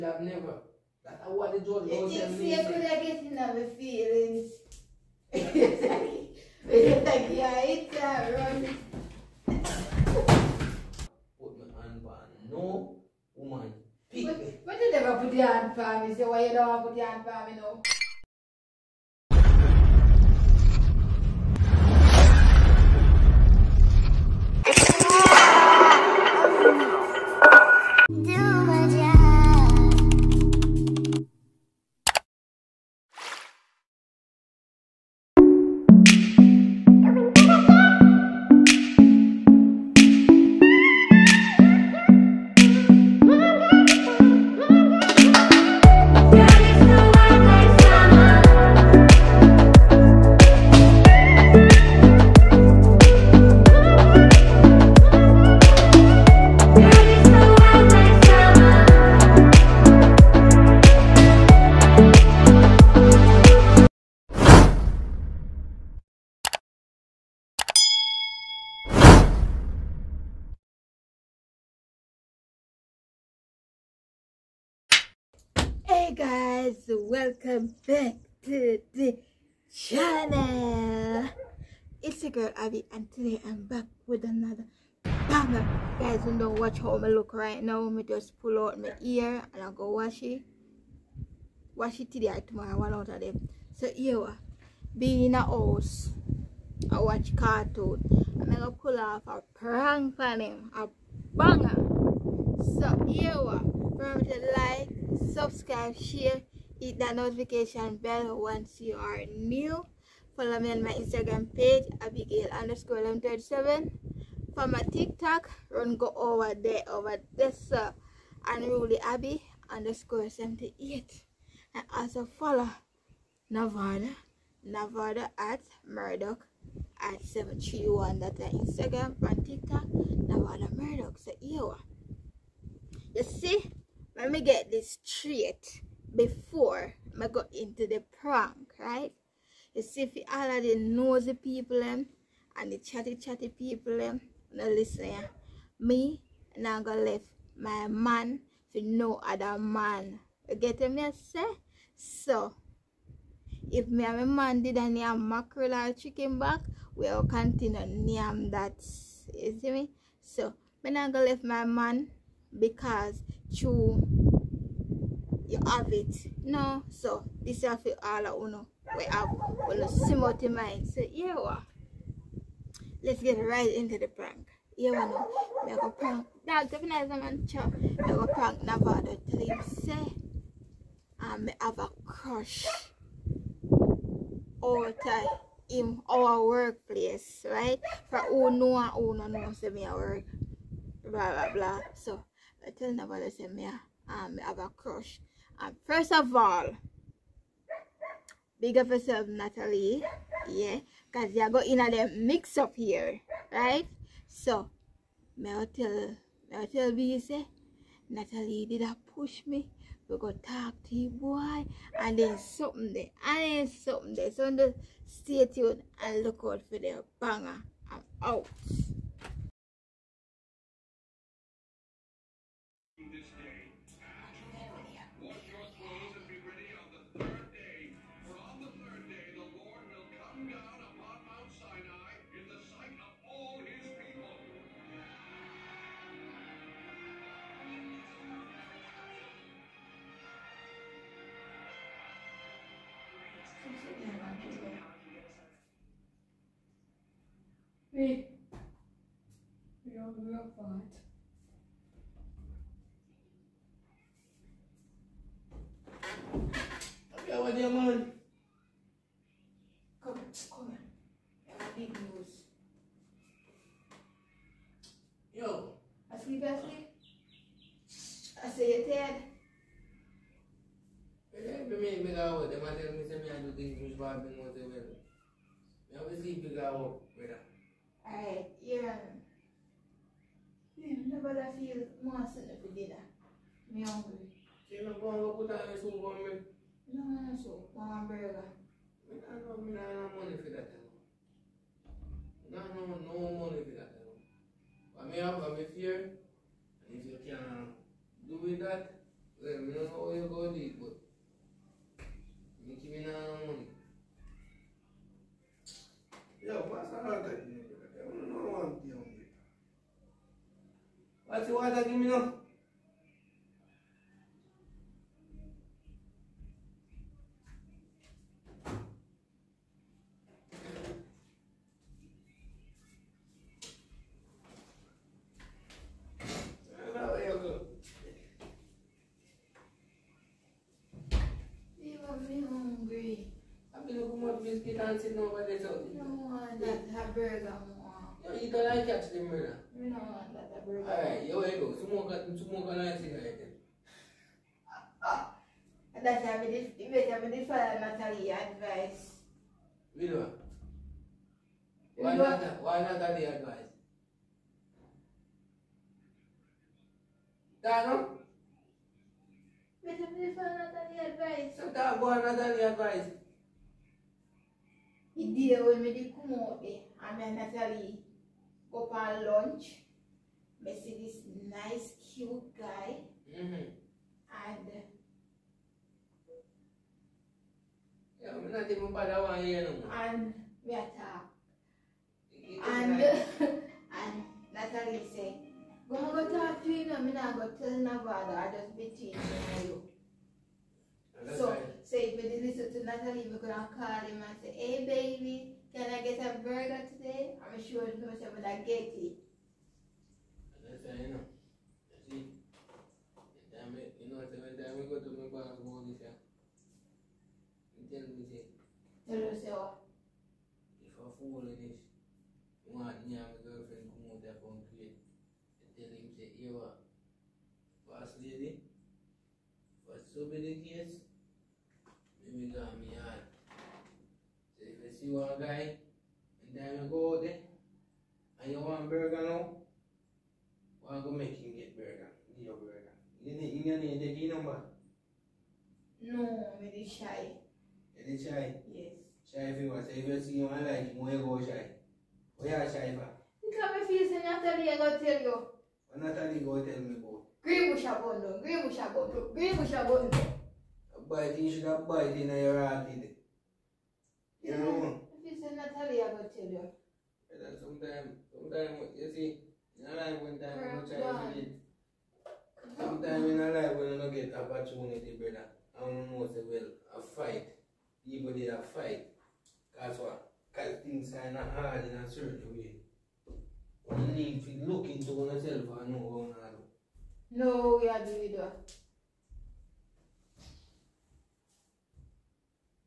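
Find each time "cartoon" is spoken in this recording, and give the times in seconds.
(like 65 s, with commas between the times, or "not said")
97 s.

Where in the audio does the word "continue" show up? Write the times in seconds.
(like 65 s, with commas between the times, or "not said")
157 s.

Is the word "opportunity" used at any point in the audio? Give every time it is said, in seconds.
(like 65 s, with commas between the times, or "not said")
464 s.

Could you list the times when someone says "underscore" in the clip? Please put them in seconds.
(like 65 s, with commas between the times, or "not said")
112 s, 119 s.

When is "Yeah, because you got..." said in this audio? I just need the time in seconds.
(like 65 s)
200 s.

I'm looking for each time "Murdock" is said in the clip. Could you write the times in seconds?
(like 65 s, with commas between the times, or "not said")
125 s, 130 s.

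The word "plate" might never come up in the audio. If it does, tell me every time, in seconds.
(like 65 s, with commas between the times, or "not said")
not said.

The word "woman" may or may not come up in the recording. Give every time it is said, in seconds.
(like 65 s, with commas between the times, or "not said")
13 s.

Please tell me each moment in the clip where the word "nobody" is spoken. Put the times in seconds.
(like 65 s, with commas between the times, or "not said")
192 s, 387 s.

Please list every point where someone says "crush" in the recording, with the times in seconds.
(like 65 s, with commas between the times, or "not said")
182 s, 194 s.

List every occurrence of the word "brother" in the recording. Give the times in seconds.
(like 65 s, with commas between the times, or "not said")
339 s, 465 s.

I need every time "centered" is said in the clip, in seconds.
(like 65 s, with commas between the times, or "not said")
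not said.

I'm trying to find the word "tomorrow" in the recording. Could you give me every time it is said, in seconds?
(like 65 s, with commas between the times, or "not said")
92 s, 223 s.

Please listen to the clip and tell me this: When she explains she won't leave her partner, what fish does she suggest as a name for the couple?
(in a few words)
mackerel.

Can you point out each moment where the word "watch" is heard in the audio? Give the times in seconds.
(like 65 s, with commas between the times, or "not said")
86 s, 96 s.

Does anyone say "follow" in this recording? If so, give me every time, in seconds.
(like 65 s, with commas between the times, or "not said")
110 s, 122 s.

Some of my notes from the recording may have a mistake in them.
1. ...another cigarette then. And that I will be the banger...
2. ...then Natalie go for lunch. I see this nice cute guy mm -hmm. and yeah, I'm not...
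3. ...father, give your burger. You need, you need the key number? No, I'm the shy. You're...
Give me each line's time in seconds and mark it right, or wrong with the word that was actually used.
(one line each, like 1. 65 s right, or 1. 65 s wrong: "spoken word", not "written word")
1. 342 s wrong: "father", not "banger"
2. 367 s right
3. 431 s wrong: "burger", not "father".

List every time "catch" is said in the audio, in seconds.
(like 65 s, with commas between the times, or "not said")
338 s.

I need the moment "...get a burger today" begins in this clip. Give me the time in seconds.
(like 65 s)
396 s.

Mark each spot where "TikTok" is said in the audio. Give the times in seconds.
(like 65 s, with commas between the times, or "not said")
114 s, 129 s.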